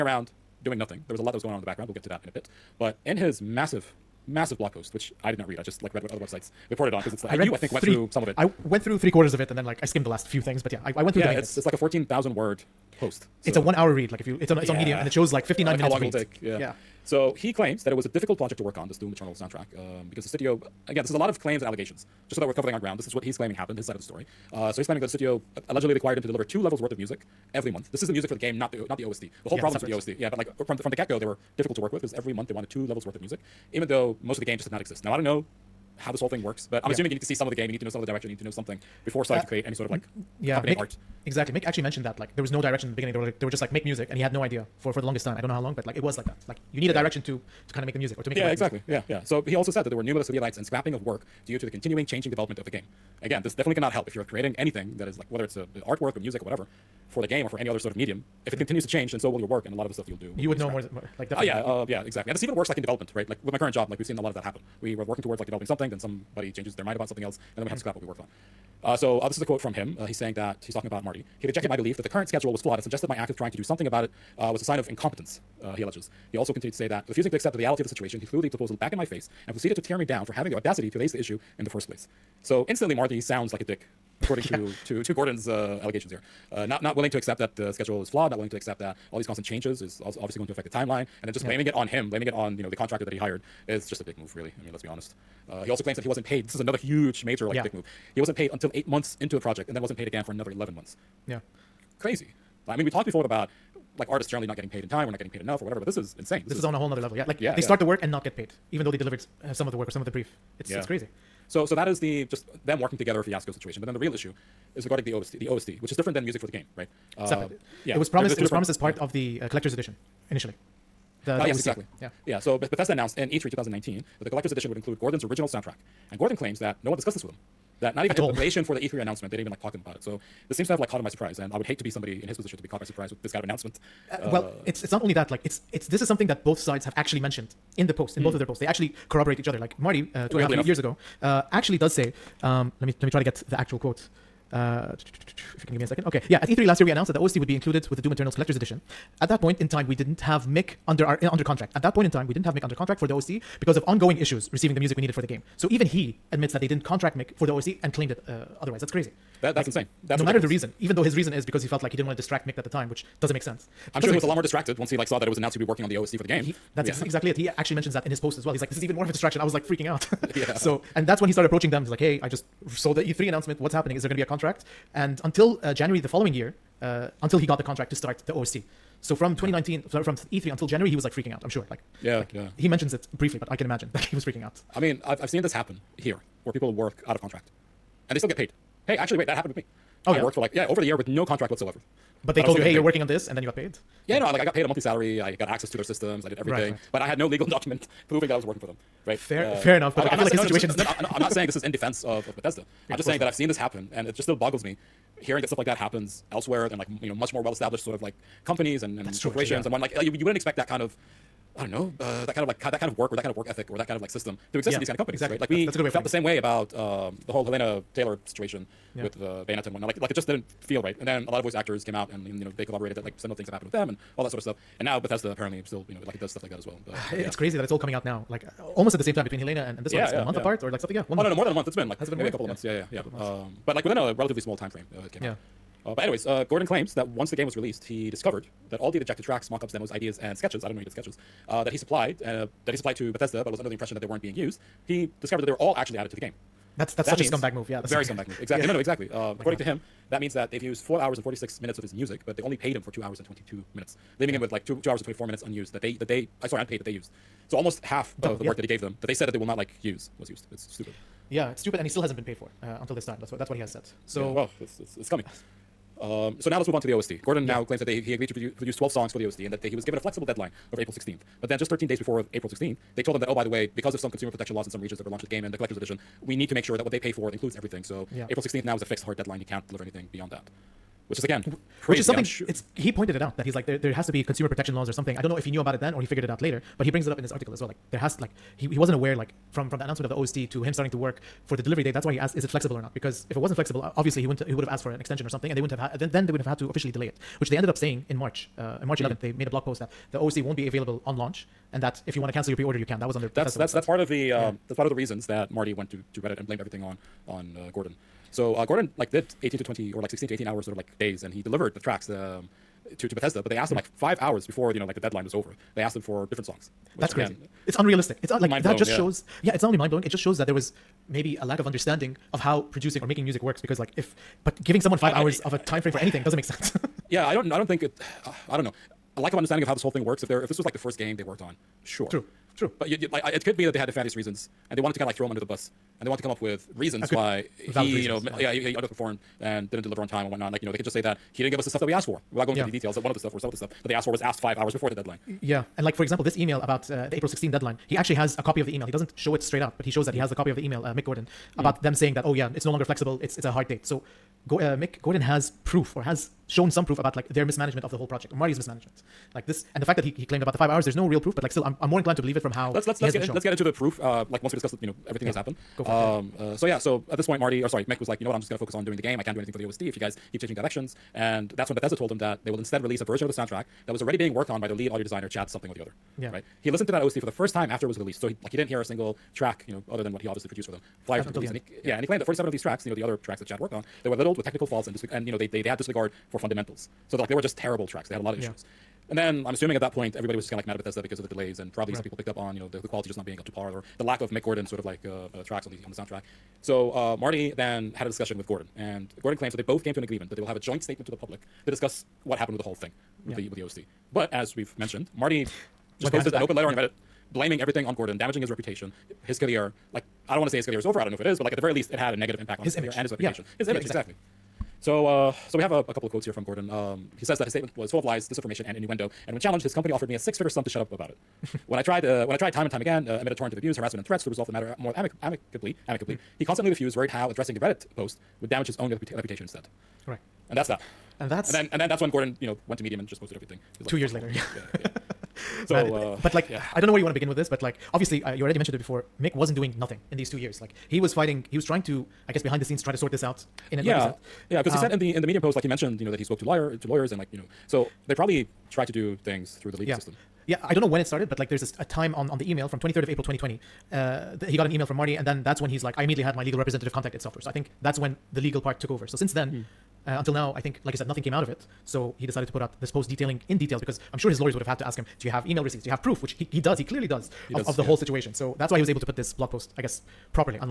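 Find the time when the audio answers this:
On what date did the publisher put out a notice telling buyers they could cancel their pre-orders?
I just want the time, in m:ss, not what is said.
4:58.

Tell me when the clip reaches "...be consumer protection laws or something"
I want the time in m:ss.
4:44.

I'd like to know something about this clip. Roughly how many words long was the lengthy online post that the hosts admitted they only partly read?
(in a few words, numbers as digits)
14,000.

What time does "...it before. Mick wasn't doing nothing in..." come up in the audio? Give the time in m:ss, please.
7:18.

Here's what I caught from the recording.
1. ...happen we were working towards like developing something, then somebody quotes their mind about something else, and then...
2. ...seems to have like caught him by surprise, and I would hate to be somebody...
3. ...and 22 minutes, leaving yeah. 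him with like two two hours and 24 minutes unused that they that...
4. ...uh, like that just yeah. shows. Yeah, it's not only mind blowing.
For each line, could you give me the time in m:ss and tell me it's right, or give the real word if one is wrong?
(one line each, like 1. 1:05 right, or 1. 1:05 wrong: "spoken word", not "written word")
1. 1:04 wrong: "changes", not "quotes"
2. 2:10 right
3. 4:13 right
4. 5:18 right.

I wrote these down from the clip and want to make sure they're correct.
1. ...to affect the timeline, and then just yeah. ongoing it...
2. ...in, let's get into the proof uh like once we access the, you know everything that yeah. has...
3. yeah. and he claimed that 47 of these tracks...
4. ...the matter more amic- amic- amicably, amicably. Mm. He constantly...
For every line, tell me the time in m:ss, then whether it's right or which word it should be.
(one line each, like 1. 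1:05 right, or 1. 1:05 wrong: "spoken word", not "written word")
1. 1:30 wrong: "blaming", not "ongoing"
2. 6:03 wrong: "discuss", not "access"
3. 6:21 right
4. 7:04 right.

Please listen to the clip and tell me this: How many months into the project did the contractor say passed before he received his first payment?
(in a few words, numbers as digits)
8 months.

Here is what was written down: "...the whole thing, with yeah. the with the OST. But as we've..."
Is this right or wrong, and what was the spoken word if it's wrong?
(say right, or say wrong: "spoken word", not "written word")
right.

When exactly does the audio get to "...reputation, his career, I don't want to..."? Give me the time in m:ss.
6:48.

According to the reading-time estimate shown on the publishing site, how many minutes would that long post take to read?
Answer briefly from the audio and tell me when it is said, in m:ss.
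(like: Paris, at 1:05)
59, at 0:15.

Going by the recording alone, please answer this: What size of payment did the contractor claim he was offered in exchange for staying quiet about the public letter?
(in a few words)
six-figure sum.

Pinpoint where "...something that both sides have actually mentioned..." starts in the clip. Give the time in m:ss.
2:16.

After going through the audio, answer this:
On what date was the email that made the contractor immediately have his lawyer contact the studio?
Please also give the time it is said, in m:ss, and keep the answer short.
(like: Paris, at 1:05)
23 April 2020, at 7:32.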